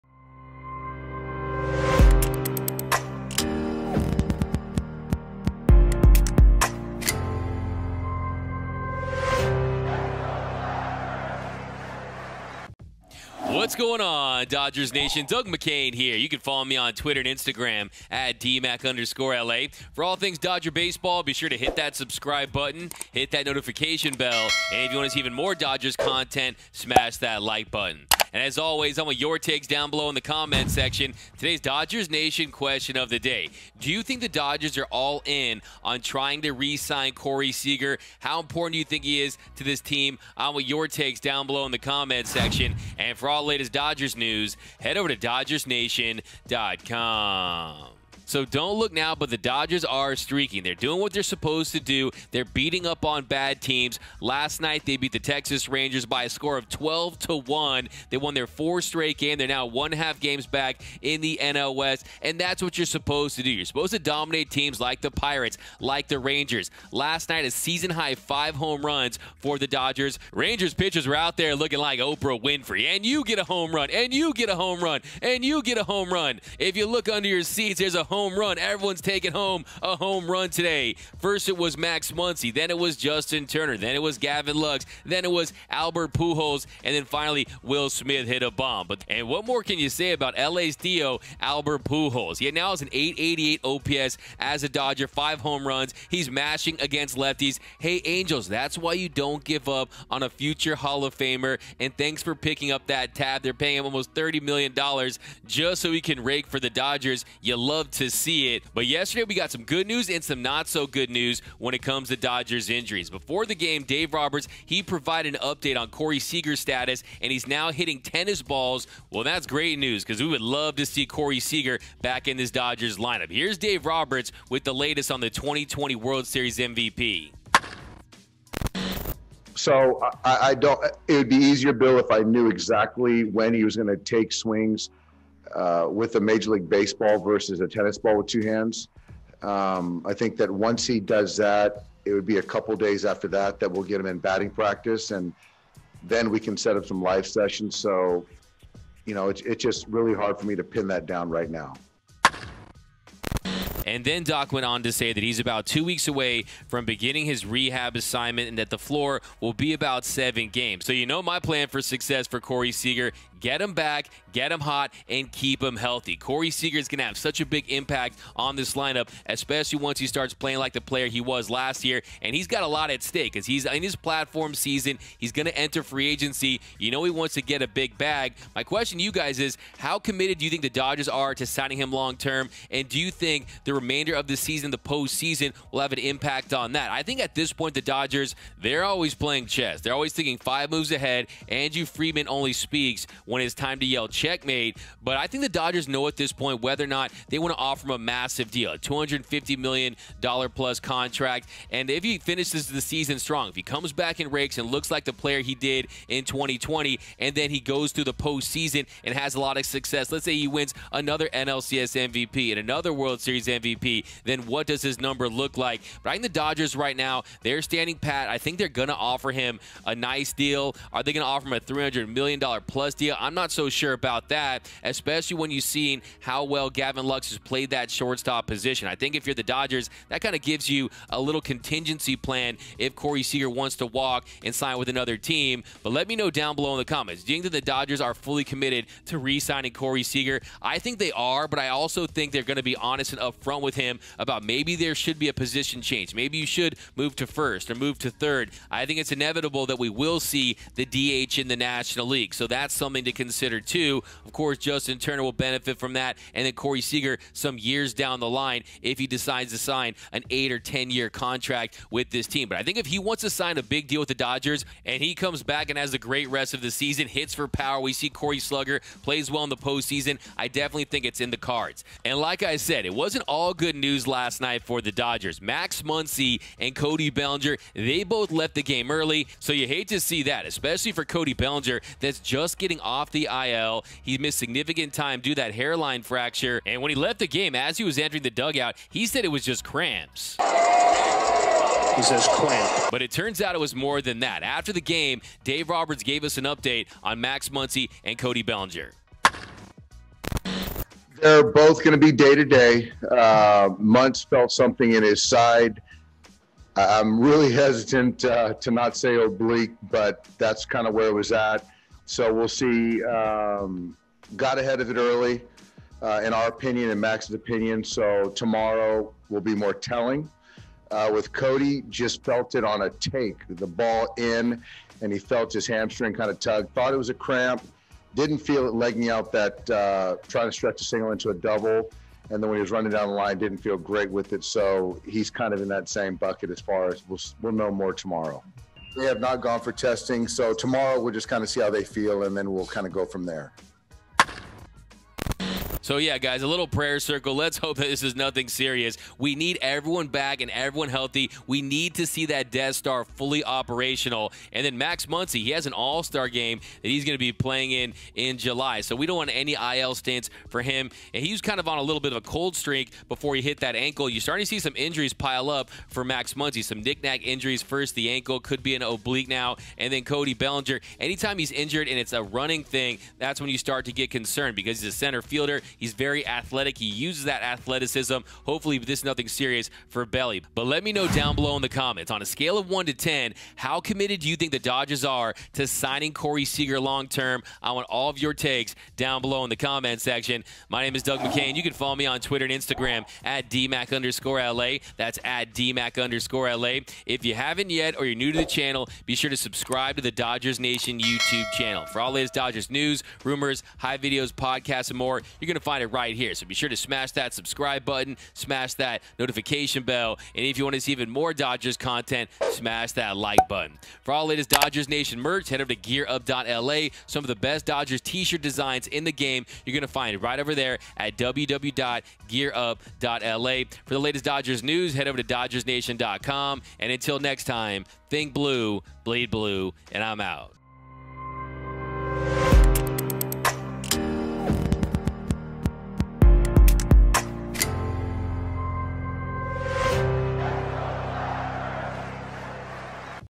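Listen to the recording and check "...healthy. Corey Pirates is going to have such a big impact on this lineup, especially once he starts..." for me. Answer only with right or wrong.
wrong.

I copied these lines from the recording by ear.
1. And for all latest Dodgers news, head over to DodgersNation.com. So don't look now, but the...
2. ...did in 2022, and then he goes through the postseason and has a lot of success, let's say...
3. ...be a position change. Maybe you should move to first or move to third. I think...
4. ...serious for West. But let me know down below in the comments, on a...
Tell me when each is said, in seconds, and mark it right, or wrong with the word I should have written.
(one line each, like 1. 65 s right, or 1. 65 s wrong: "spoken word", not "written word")
1. 42 s right
2. 205 s wrong: "2020", not "2022"
3. 245 s right
4. 379 s wrong: "Belly", not "West".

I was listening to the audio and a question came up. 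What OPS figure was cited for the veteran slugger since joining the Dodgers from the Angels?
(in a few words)
.888.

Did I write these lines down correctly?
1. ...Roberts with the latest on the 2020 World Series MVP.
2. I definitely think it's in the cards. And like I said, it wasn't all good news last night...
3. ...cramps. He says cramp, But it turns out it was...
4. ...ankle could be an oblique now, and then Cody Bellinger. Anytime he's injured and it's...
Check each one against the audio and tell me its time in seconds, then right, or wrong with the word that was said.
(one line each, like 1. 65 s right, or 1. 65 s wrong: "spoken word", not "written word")
1. 123 s right
2. 270 s right
3. 289 s right
4. 368 s right.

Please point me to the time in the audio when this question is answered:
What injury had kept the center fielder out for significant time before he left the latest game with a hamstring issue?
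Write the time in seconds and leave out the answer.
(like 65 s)
285 s.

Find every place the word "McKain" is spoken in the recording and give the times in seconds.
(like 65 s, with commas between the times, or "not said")
15 s, 391 s.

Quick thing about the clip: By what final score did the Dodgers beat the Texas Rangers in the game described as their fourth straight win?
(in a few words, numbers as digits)
12 to 1.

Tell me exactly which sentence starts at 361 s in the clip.
And he was kind of on a little bit of a cold streak before he hit that ankle.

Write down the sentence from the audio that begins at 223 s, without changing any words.
I'm not so sure about that, especially when you've seen how well Gavin Lux has played that shortstop position.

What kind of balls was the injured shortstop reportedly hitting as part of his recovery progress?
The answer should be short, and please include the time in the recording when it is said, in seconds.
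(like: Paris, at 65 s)
Tennis balls, at 118 s.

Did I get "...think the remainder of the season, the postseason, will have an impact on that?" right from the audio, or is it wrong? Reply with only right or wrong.
right.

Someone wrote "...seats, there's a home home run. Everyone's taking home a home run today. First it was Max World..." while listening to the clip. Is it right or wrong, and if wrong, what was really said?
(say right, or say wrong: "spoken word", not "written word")
wrong: "Muncy", not "World".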